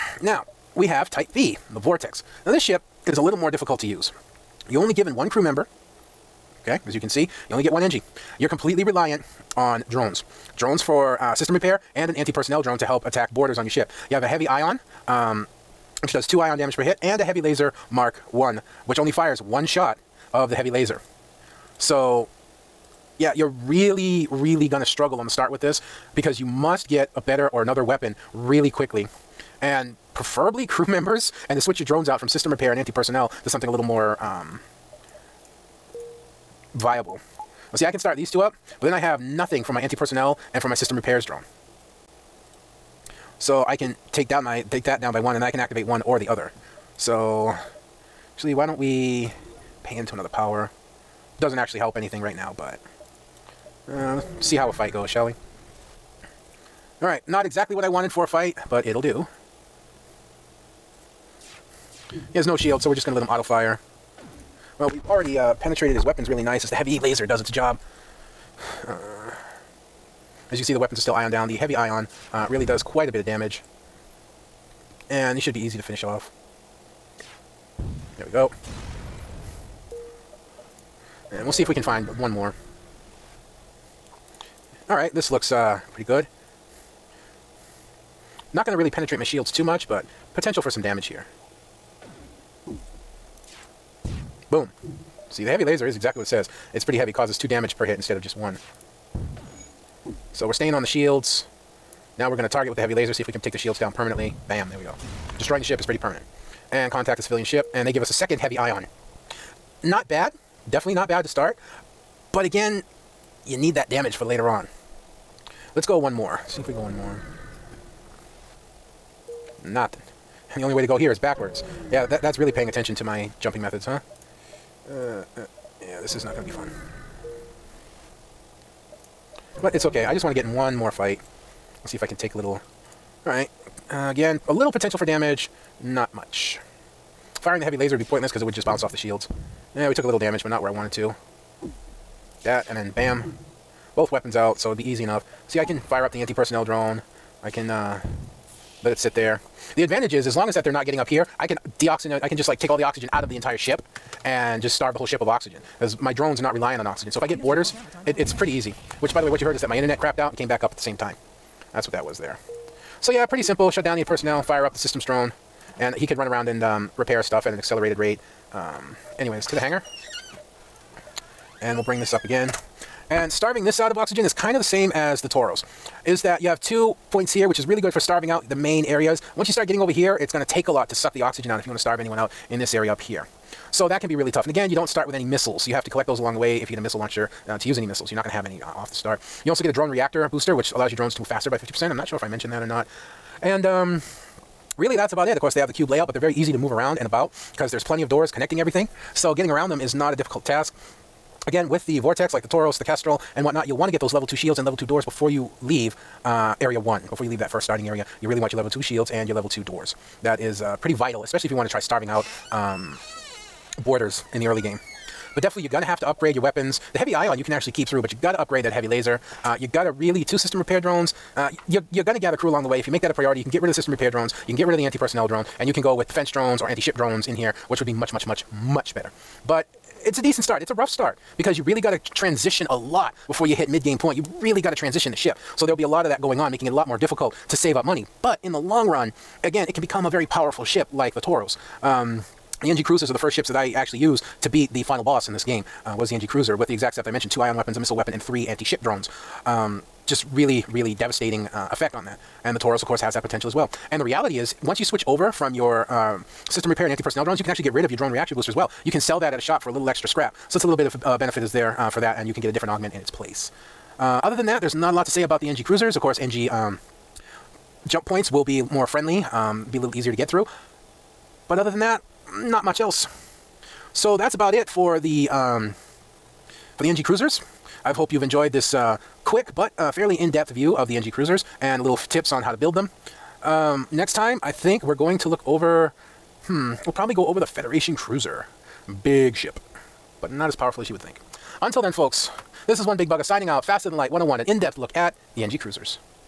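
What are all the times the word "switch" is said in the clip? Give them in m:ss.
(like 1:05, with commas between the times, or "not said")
0:31, 4:14.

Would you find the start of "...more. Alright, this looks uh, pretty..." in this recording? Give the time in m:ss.
1:22.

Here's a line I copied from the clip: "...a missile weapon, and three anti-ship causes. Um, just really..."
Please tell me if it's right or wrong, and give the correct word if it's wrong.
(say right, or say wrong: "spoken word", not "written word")
wrong: "drones", not "causes".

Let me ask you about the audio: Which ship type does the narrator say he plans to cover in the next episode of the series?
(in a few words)
Federation Cruiser.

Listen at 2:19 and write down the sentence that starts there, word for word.
Yeah, we took a little damage, but not where I wanted to.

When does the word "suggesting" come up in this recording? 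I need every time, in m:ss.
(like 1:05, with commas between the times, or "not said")
not said.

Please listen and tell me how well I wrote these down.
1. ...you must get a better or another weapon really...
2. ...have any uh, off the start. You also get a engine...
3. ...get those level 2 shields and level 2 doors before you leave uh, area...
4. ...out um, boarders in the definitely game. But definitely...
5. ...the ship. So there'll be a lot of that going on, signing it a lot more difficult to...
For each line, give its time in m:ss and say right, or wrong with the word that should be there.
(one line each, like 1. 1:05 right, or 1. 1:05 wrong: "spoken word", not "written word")
1. 0:26 right
2. 3:08 wrong: "drone", not "engine"
3. 3:23 right
4. 3:32 wrong: "early", not "definitely"
5. 3:55 wrong: "making", not "signing".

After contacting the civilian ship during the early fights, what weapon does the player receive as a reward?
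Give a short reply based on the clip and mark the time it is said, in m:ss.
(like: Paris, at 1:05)
A second heavy ion, at 1:48.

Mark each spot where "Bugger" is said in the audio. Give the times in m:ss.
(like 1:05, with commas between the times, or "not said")
4:53.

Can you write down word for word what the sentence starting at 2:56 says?
Is that you have two points here, which is really good for starving out the main areas.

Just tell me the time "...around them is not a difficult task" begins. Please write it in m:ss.
3:19.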